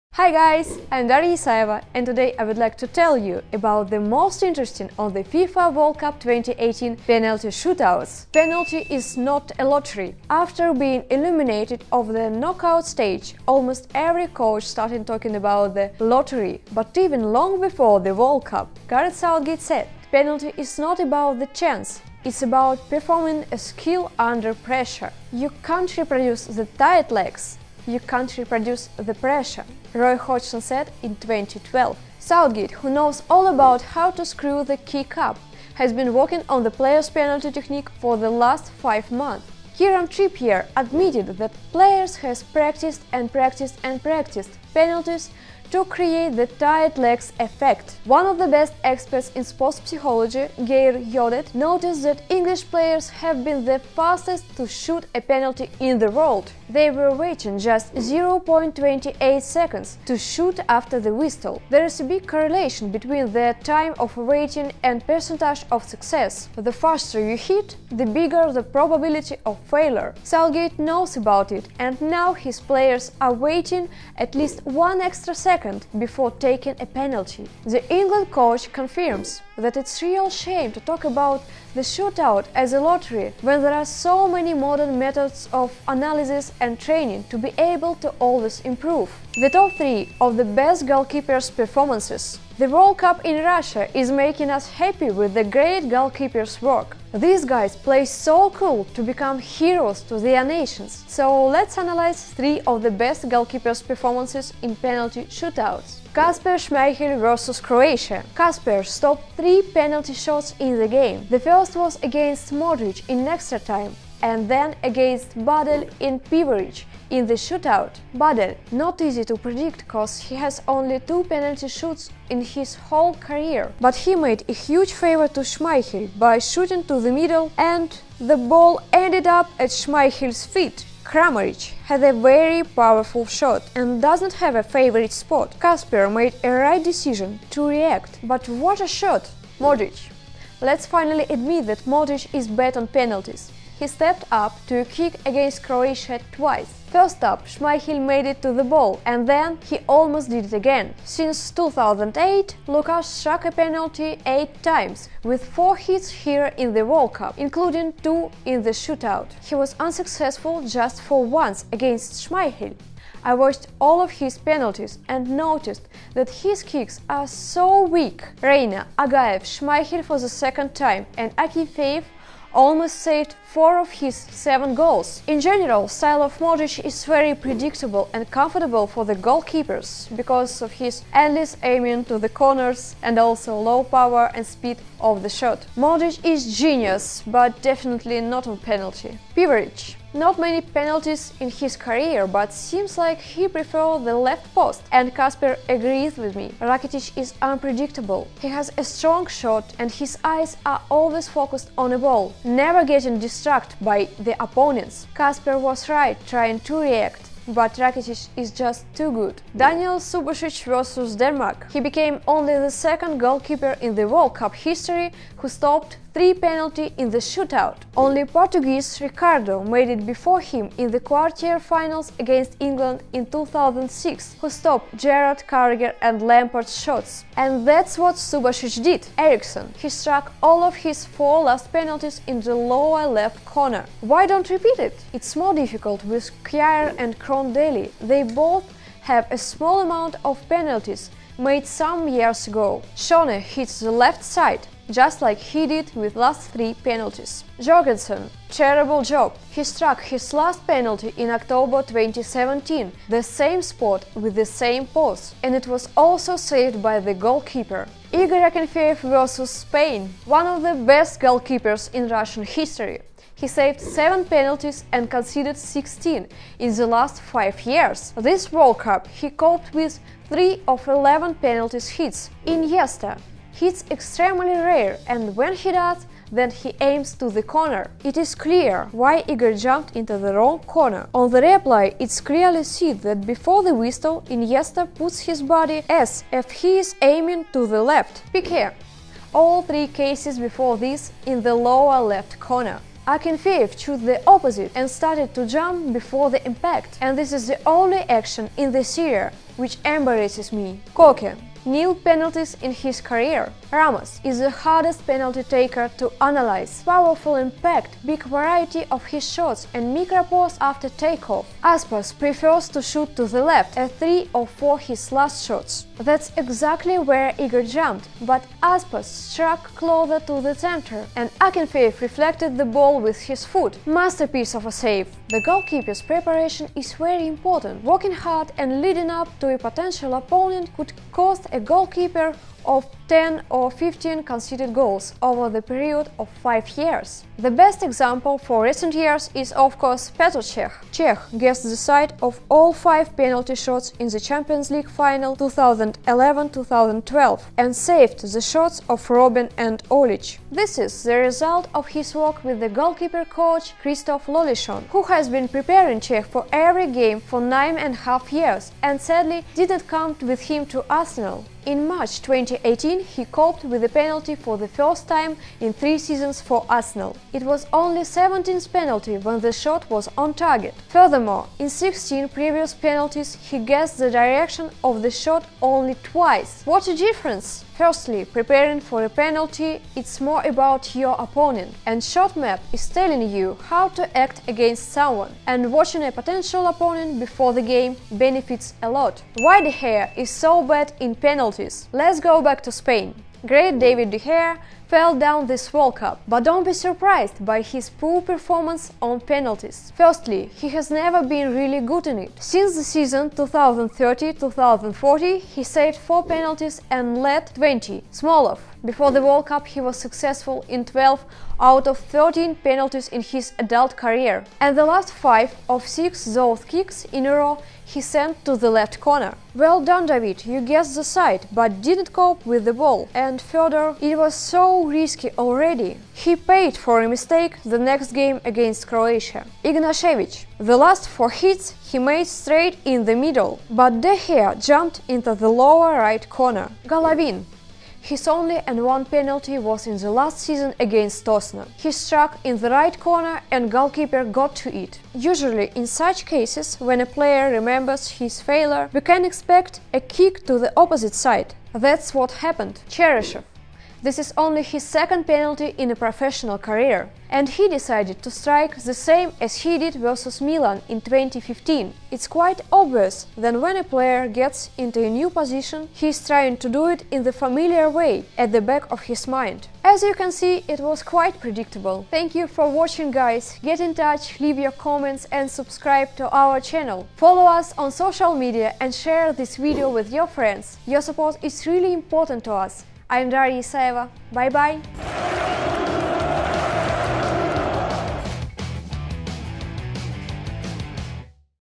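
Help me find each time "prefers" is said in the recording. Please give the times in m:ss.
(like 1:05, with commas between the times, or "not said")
3:13, 5:12.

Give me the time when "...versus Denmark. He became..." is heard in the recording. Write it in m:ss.
3:30.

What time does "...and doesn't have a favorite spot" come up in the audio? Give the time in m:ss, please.
2:13.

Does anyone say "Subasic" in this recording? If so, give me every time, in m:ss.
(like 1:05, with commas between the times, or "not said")
3:29, 3:48.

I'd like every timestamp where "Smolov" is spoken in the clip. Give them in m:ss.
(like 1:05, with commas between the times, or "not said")
6:48.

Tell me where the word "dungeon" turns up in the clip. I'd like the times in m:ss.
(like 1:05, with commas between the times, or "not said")
not said.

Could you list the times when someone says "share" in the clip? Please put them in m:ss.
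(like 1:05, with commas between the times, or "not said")
7:58.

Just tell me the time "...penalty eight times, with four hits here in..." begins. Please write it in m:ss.
2:33.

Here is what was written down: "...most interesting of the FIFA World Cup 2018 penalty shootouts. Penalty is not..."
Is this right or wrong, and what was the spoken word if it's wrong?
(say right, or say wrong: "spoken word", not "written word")
right.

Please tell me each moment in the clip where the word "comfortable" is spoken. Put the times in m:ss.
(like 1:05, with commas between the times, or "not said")
2:58.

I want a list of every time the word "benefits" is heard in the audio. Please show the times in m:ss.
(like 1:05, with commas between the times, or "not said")
6:28.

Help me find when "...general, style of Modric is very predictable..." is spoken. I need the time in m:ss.
2:55.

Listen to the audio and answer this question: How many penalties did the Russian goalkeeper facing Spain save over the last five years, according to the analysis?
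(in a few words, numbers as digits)
7.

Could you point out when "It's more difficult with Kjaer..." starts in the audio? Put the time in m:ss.
3:55.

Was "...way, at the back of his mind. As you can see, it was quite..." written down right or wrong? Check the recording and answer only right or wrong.
right.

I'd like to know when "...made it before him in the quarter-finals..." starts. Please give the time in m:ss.
3:39.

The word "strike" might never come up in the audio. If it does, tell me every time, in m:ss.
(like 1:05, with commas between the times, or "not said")
7:38.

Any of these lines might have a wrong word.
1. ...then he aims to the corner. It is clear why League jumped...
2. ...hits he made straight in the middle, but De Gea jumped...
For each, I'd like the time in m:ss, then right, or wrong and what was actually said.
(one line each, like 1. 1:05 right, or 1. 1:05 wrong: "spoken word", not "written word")
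1. 4:36 wrong: "Igor", not "League"
2. 7:11 right.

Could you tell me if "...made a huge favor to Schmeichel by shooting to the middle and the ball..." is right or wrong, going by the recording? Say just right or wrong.
right.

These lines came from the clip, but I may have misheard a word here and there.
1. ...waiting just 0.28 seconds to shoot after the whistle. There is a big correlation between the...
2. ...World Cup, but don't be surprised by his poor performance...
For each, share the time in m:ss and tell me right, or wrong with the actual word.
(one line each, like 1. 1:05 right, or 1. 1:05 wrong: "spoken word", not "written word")
1. 0:57 right
2. 6:35 right.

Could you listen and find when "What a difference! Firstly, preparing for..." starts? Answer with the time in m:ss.
6:16.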